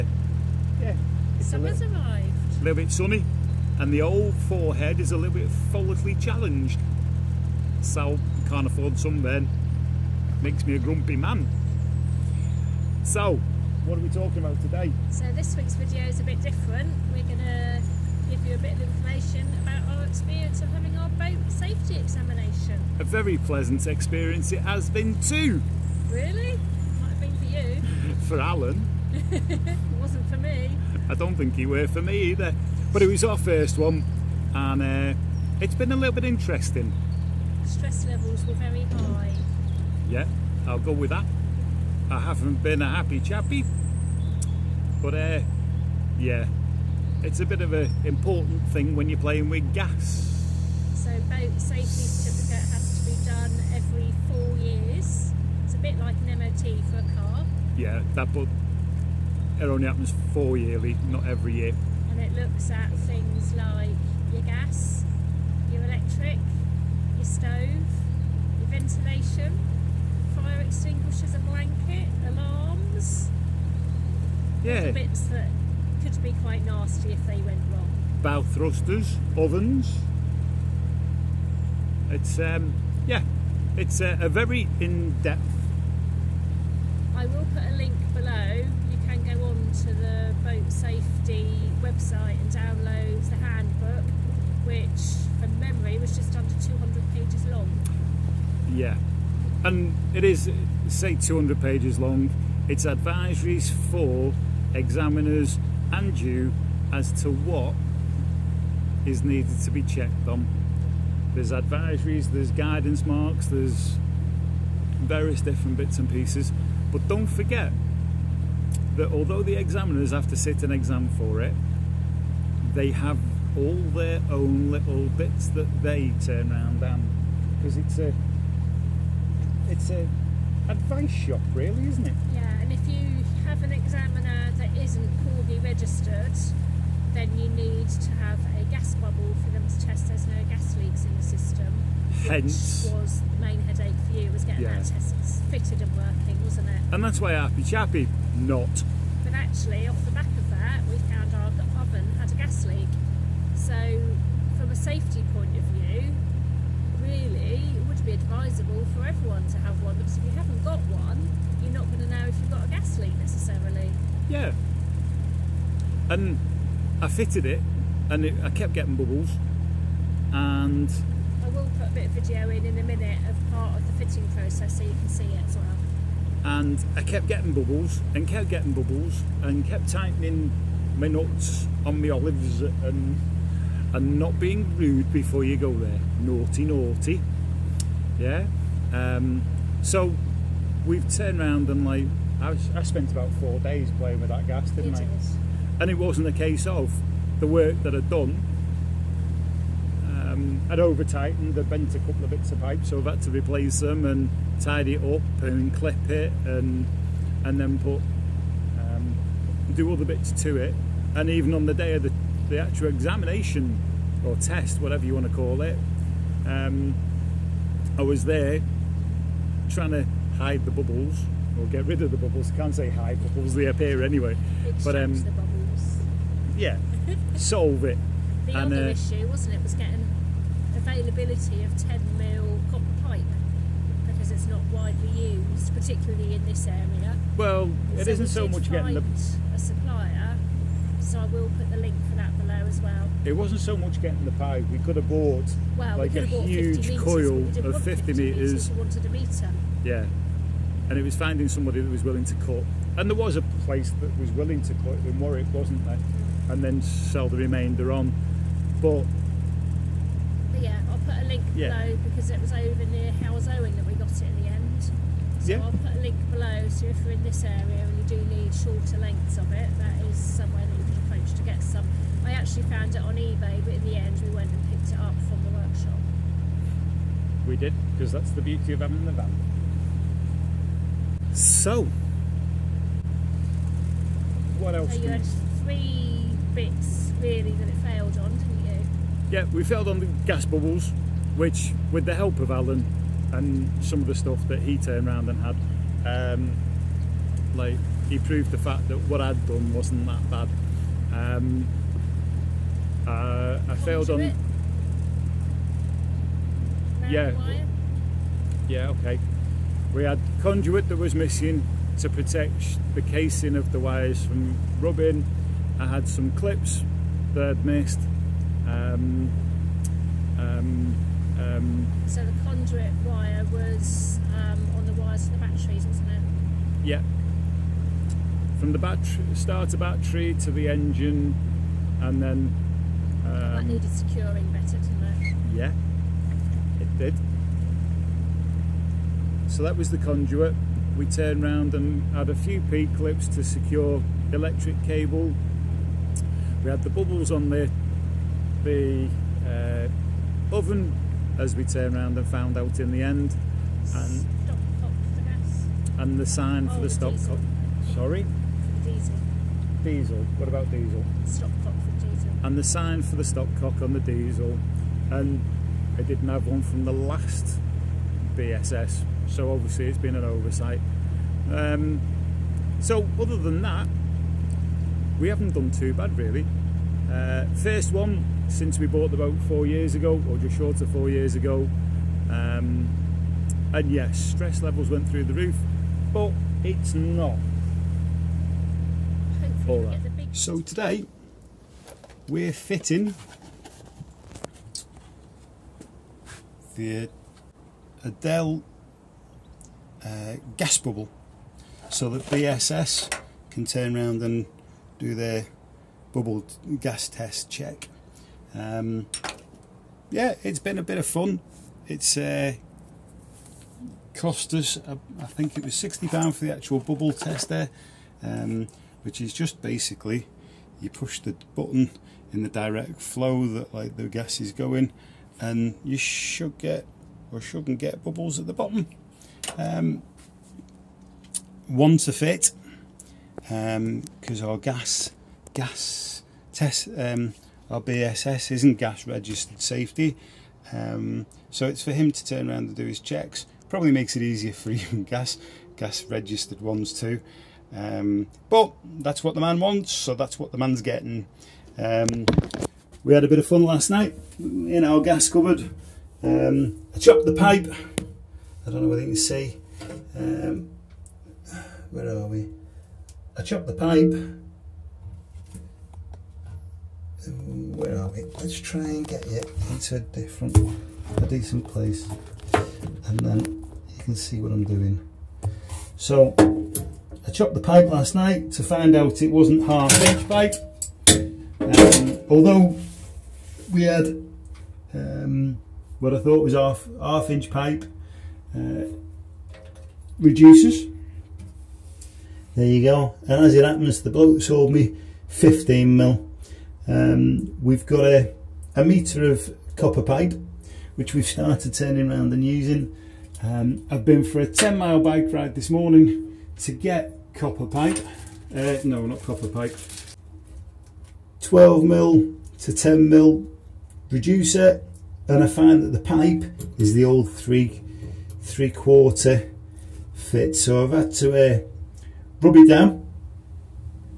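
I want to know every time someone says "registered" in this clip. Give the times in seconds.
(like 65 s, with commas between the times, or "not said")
135 s, 439 s, 446 s.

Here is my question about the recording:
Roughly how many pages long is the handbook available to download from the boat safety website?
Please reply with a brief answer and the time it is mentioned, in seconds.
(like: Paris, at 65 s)
just under 200, at 96 s.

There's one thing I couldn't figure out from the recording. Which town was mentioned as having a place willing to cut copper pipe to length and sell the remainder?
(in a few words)
Warwick.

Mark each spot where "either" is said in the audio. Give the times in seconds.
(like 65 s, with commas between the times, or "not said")
32 s.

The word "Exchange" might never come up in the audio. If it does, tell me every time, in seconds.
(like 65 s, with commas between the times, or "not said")
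224 s.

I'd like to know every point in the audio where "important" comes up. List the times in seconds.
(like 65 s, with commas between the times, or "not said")
48 s.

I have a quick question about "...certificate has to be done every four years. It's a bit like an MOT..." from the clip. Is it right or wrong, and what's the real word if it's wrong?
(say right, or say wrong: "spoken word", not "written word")
right.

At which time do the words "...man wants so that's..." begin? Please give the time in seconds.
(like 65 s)
449 s.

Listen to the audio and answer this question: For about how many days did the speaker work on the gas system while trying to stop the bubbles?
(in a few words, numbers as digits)
4.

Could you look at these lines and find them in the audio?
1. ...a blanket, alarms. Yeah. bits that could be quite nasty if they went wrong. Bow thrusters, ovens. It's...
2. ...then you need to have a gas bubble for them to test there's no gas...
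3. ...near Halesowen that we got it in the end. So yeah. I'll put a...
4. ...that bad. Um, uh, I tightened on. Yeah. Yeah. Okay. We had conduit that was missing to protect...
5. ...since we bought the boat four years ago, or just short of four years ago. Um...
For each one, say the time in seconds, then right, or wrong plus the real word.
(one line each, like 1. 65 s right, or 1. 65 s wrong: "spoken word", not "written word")
1. 71 s right
2. 137 s right
3. 262 s right
4. 300 s wrong: "failed", not "tightened"
5. 378 s right.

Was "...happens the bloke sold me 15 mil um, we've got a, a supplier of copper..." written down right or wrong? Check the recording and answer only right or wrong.
wrong.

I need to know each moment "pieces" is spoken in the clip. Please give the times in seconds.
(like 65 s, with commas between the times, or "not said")
116 s.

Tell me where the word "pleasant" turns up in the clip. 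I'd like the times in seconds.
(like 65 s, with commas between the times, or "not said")
23 s.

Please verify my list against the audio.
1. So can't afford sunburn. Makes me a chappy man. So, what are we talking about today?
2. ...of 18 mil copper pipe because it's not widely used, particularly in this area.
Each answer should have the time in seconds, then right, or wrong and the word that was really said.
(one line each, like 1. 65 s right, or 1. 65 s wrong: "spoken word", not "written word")
1. 7 s wrong: "grumpy", not "chappy"
2. 231 s wrong: "10", not "18".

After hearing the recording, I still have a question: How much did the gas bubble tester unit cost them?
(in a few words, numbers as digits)
£60.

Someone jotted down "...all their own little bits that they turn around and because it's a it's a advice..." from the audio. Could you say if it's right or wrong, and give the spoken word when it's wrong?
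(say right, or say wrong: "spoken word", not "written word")
right.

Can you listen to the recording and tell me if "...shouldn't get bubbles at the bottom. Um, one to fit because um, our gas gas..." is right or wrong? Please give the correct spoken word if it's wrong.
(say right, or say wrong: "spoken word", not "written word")
right.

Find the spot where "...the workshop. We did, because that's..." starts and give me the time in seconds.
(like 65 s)
275 s.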